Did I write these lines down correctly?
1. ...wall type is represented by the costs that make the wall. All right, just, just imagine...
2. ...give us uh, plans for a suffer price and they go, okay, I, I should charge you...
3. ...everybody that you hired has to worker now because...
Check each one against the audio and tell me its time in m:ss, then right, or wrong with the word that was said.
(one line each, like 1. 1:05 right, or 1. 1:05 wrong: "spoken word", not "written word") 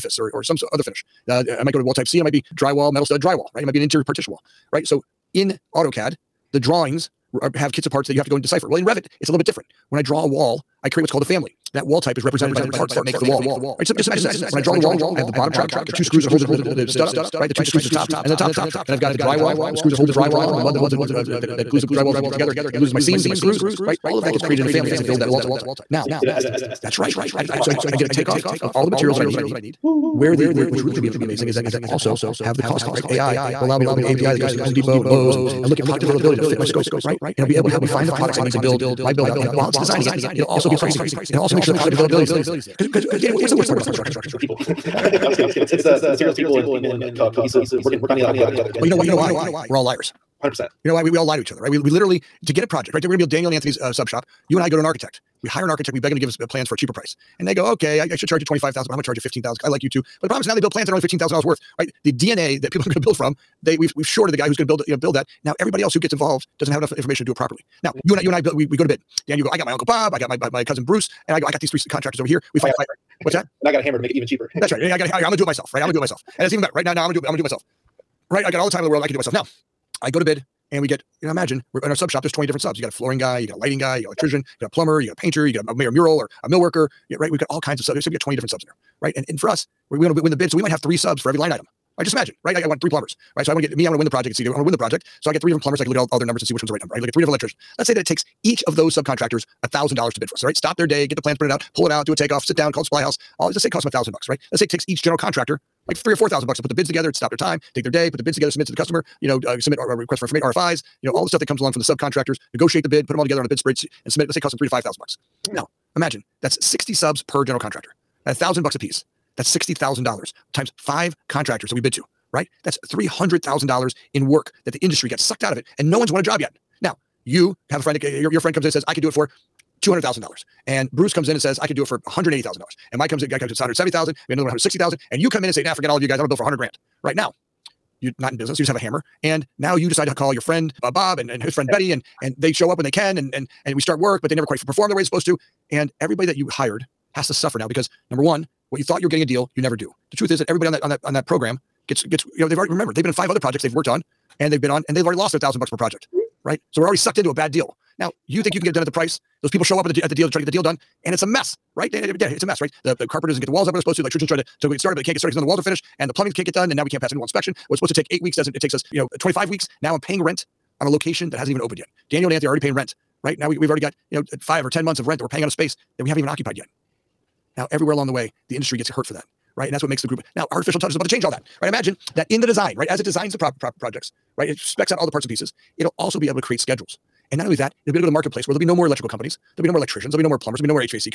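1. 0:11 wrong: "parts", not "costs"
2. 0:56 wrong: "cheaper", not "suffer"
3. 2:26 wrong: "suffer", not "worker".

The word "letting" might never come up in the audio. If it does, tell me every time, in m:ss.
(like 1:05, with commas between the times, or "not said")
not said.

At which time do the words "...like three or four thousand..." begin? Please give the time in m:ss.
1:45.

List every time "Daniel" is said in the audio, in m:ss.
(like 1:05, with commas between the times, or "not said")
0:53, 2:52.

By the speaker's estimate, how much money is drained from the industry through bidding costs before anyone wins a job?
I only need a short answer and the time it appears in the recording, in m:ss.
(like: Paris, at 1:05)
$300,000, at 2:02.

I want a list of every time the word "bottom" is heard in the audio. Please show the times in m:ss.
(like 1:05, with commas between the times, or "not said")
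0:15.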